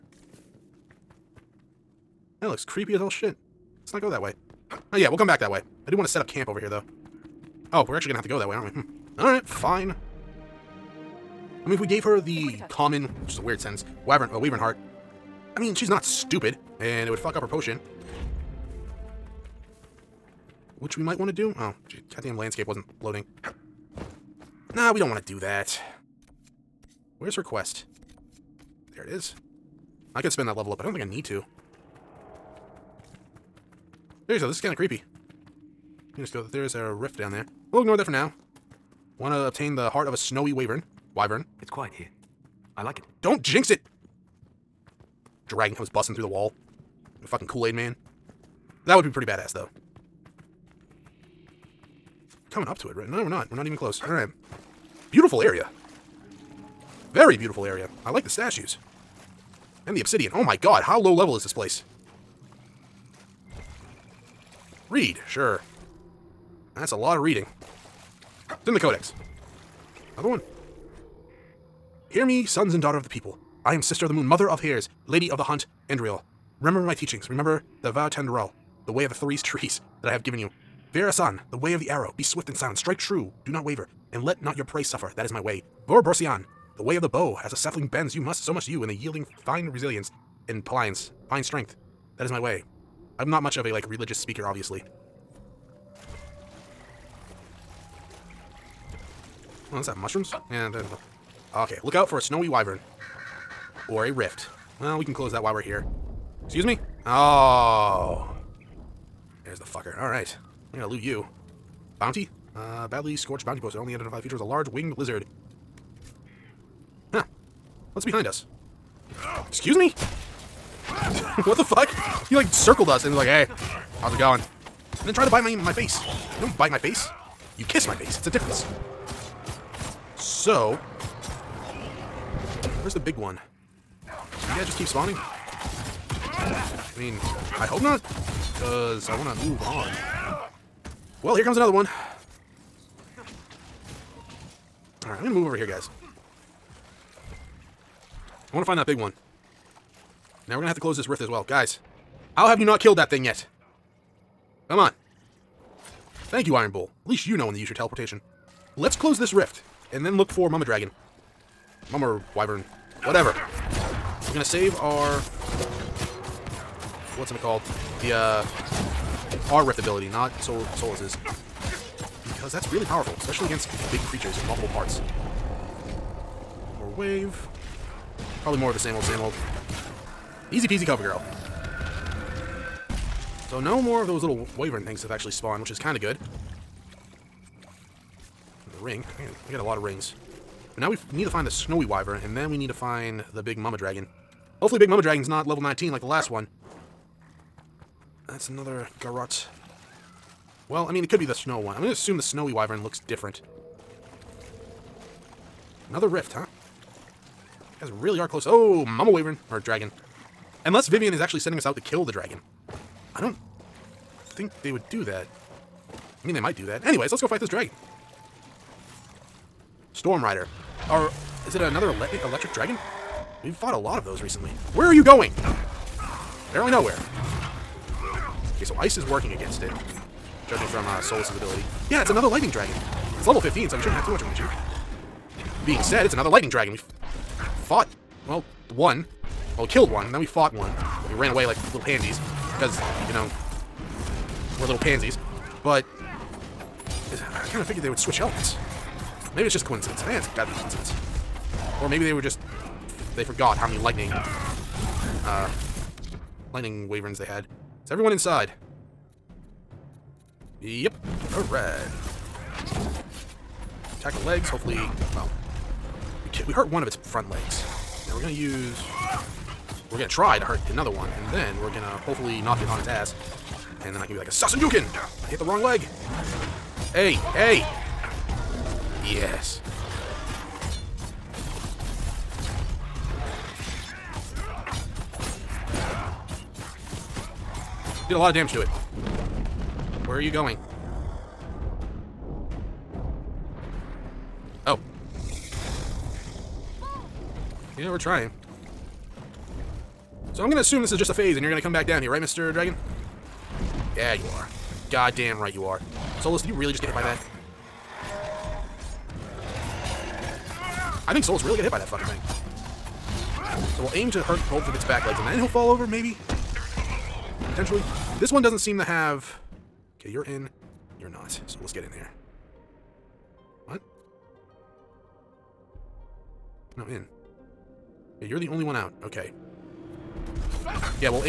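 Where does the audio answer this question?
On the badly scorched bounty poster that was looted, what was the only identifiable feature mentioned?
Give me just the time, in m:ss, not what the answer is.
1:54.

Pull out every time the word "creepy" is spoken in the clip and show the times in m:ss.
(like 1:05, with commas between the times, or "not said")
0:02, 0:34.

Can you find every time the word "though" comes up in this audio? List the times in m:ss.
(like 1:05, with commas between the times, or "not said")
0:06, 0:49.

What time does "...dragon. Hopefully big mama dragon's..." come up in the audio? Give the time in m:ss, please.
3:13.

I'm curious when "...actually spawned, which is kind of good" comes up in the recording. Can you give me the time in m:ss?
3:05.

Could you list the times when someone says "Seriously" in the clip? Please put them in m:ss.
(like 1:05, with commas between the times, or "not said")
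0:34.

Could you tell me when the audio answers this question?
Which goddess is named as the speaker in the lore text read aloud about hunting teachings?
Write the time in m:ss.
1:15.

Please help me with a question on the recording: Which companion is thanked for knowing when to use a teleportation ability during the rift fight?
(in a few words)
Iron Bull.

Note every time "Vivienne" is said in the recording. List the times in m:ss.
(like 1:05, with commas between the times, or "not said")
3:30.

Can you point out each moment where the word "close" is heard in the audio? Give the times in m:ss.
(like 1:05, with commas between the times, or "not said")
0:53, 1:45, 2:30, 2:38, 3:28.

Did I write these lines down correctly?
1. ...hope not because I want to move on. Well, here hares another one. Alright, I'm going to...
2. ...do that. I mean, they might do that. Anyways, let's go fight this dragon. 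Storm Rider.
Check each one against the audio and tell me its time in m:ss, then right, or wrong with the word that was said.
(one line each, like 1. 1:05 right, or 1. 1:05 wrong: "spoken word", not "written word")
1. 2:17 wrong: "comes", not "hares"
2. 3:34 right.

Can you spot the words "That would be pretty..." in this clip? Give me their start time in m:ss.
0:48.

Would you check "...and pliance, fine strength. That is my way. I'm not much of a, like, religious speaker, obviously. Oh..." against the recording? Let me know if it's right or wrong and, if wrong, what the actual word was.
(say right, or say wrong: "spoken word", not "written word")
right.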